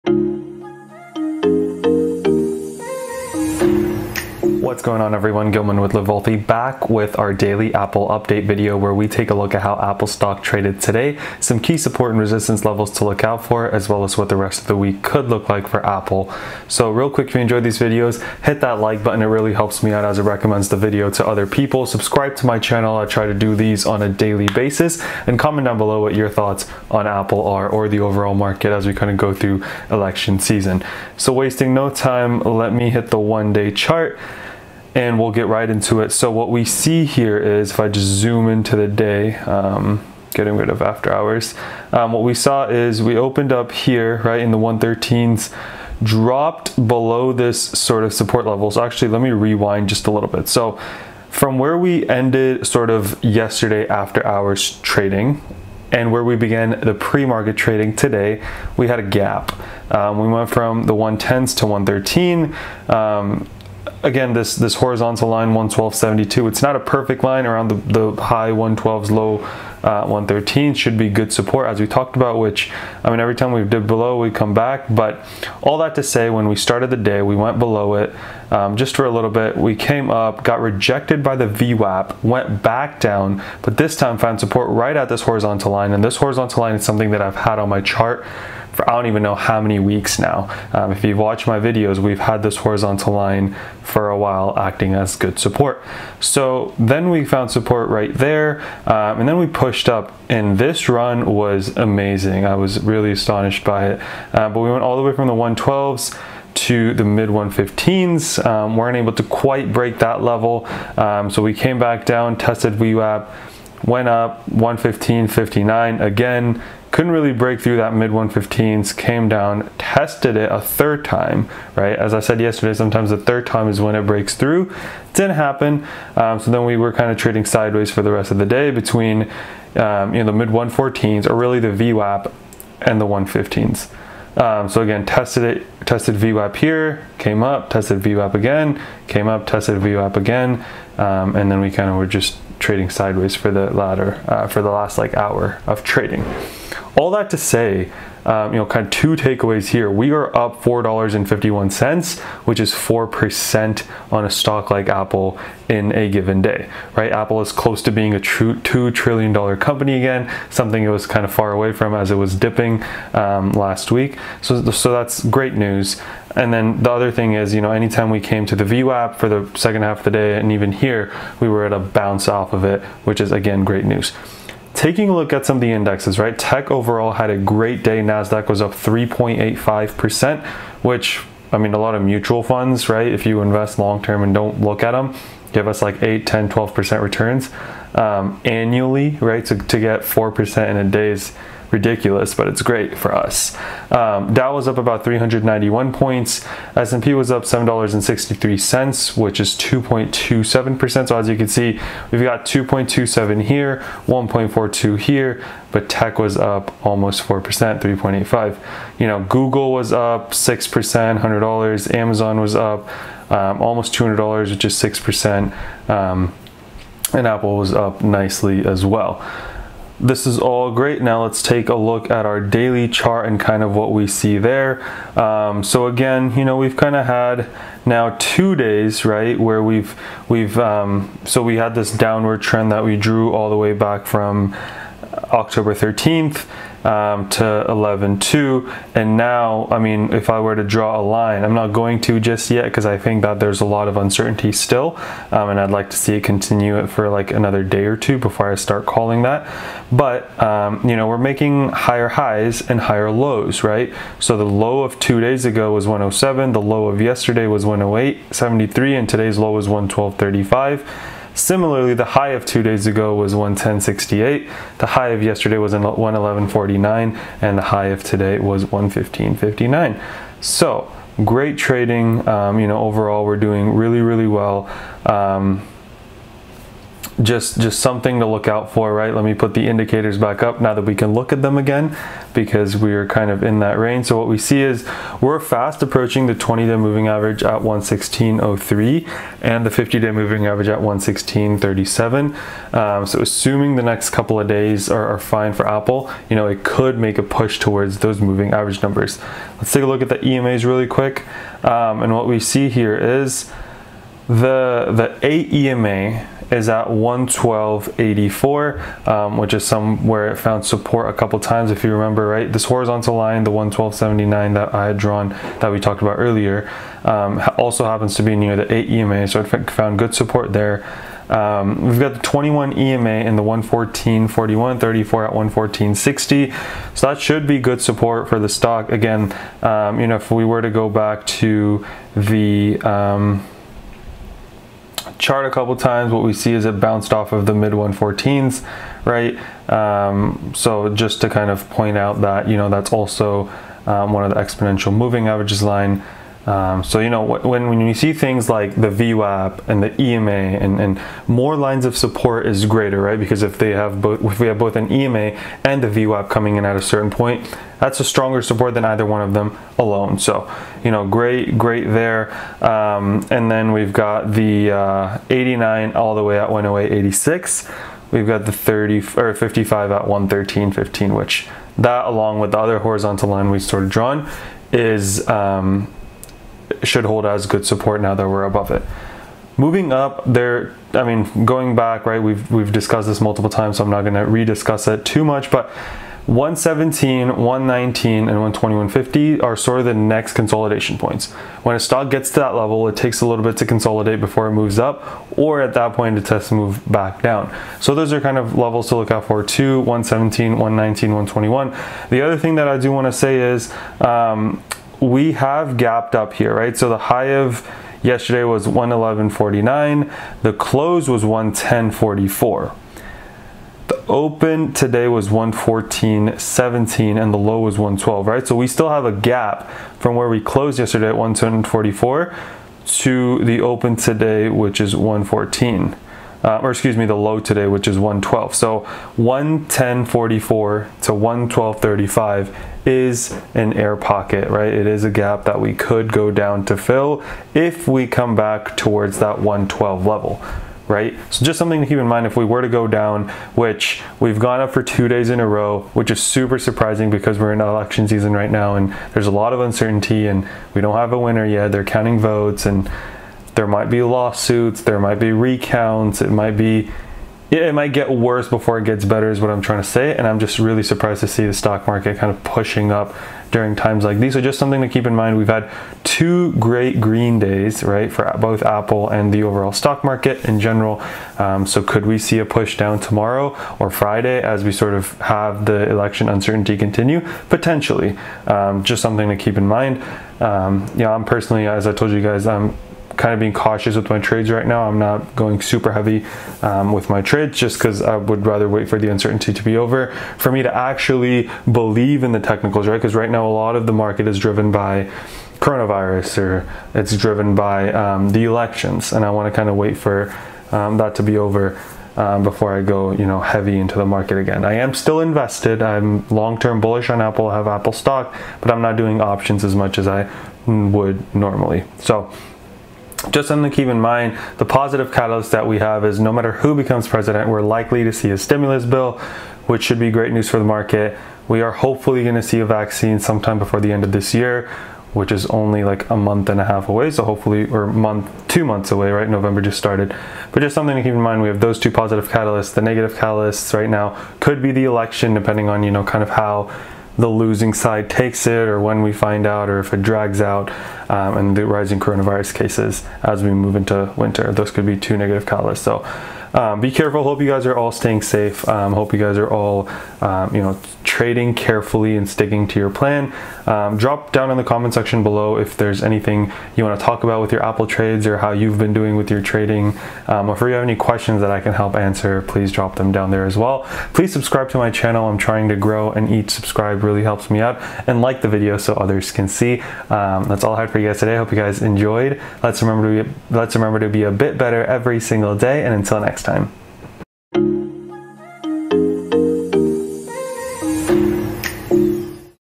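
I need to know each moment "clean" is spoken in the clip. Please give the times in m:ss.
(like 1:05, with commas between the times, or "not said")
not said.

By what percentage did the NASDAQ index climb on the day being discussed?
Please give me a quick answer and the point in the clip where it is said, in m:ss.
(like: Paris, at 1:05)
3.85%, at 2:58.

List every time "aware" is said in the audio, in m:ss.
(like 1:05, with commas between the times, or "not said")
not said.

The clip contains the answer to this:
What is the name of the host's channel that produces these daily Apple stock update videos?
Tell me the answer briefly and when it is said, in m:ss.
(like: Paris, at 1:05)
Live Wellthy, at 0:05.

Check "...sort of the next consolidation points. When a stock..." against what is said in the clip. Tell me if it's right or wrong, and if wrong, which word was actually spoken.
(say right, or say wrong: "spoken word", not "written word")
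right.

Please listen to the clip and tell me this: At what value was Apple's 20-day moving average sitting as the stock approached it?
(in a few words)
116.03.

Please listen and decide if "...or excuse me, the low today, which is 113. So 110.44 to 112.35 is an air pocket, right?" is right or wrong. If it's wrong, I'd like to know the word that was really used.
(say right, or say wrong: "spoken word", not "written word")
wrong: "112", not "113".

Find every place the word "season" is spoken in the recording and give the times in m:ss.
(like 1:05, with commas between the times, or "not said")
0:30, 7:28.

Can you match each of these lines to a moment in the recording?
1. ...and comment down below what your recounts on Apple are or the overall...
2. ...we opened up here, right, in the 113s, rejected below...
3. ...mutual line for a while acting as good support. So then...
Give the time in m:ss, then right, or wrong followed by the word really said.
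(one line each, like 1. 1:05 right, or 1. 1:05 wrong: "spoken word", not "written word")
1. 0:25 wrong: "thoughts", not "recounts"
2. 0:43 wrong: "dropped", not "rejected"
3. 1:32 wrong: "horizontal", not "mutual".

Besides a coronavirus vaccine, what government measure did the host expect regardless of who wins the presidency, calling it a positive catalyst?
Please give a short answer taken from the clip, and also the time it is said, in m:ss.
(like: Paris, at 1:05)
stimulus bill, at 8:38.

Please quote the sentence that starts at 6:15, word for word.
Um, should hold as good support now that we're above it.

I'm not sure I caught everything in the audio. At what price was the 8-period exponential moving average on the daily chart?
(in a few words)
112.84.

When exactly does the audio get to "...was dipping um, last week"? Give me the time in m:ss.
2:42.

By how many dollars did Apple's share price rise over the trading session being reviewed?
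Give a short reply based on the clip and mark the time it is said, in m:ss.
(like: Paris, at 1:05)
$4.51, at 2:30.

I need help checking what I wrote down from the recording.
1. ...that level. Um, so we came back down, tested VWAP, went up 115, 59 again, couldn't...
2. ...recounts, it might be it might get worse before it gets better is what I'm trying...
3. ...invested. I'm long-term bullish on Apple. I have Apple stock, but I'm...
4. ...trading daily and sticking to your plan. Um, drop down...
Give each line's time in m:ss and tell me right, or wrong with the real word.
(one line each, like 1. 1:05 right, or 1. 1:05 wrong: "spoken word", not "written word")
1. 1:49 right
2. 7:35 right
3. 8:25 right
4. 9:11 wrong: "carefully", not "daily".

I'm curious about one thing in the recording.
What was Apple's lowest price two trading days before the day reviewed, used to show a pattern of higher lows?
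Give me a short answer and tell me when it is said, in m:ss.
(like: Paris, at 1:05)
107, at 4:15.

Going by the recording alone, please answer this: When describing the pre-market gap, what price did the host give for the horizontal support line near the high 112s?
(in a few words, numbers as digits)
112.72.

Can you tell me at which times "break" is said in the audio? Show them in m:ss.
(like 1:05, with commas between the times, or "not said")
1:49, 1:57, 2:04.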